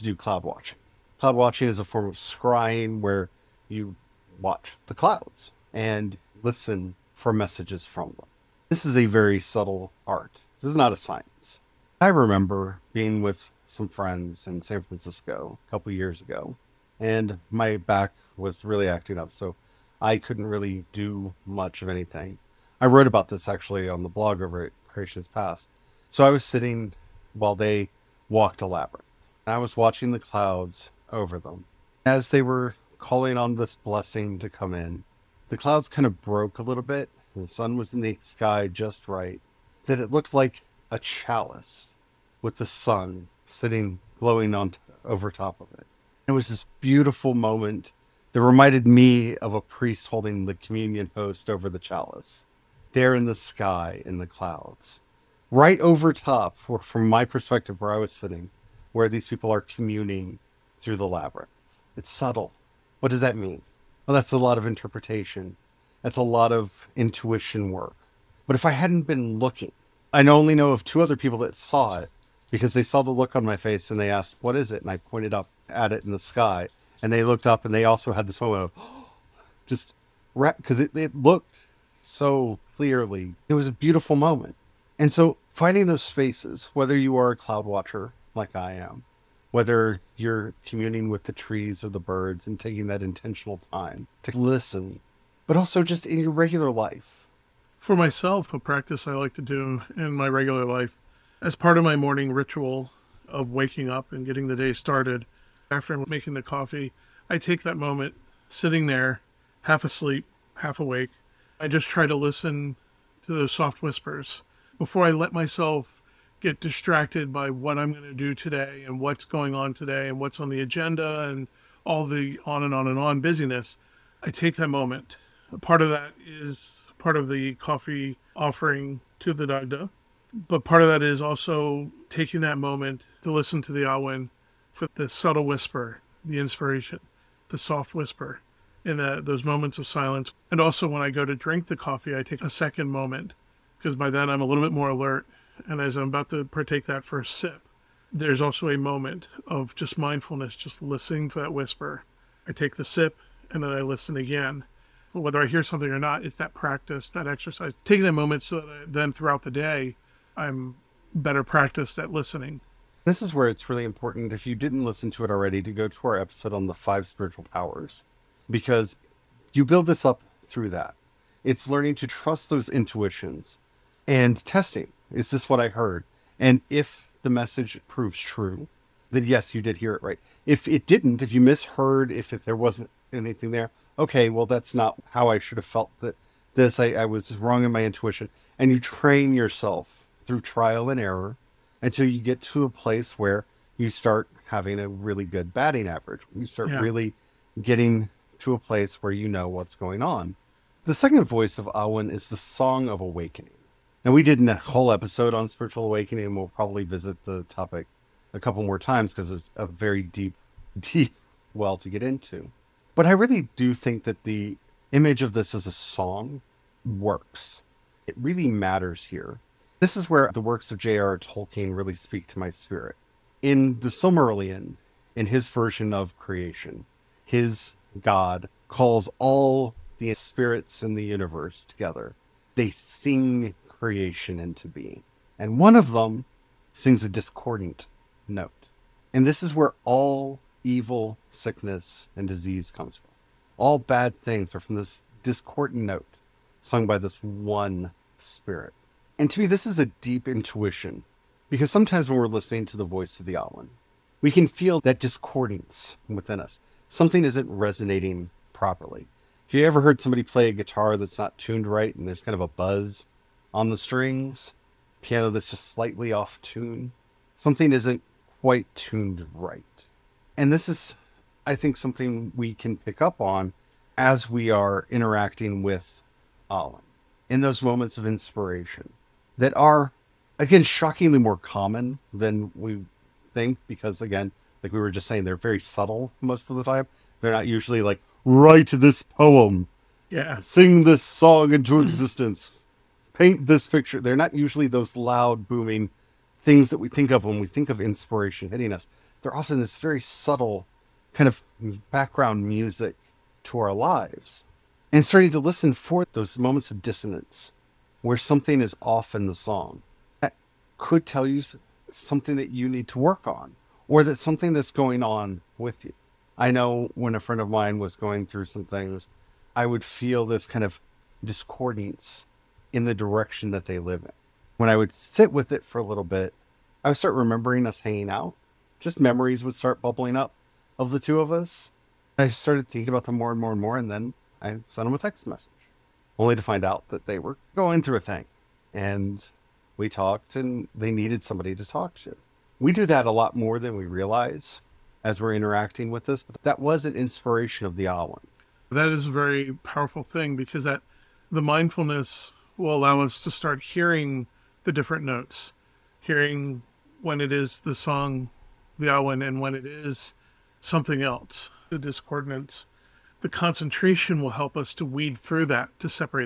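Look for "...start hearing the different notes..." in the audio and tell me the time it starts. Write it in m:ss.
5:53.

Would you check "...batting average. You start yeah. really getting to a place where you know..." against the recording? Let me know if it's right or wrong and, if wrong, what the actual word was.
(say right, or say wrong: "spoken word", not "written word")
right.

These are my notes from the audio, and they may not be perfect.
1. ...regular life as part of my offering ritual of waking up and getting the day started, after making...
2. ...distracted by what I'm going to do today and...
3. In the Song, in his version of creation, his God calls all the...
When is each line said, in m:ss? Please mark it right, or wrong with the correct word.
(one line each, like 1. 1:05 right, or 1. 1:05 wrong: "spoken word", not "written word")
1. 1:40 wrong: "morning", not "offering"
2. 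1:56 right
3. 3:43 wrong: "Silmarillion", not "Song".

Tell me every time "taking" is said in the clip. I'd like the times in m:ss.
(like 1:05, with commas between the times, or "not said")
1:32, 2:12, 2:37.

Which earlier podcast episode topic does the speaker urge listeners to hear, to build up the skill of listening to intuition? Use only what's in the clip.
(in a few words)
Five spiritual powers.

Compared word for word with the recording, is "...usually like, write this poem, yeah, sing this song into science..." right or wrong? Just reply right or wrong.
wrong.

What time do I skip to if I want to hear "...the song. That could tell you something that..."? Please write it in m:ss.
5:09.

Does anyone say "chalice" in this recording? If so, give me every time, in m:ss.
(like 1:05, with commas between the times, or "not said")
0:40, 0:51.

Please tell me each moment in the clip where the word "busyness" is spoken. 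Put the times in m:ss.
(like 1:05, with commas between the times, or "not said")
2:03.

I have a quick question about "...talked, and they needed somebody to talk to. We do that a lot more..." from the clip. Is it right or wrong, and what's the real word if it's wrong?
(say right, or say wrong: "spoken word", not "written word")
right.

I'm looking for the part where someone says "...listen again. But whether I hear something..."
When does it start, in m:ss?
2:33.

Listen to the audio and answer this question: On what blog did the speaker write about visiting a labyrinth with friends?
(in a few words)
Creation's Paths.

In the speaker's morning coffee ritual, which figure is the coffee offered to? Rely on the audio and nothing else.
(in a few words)
The Dagda.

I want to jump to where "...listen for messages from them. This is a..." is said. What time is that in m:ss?
0:06.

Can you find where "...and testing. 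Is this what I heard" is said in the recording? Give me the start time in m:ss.
2:54.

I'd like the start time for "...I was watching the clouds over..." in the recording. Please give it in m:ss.
0:29.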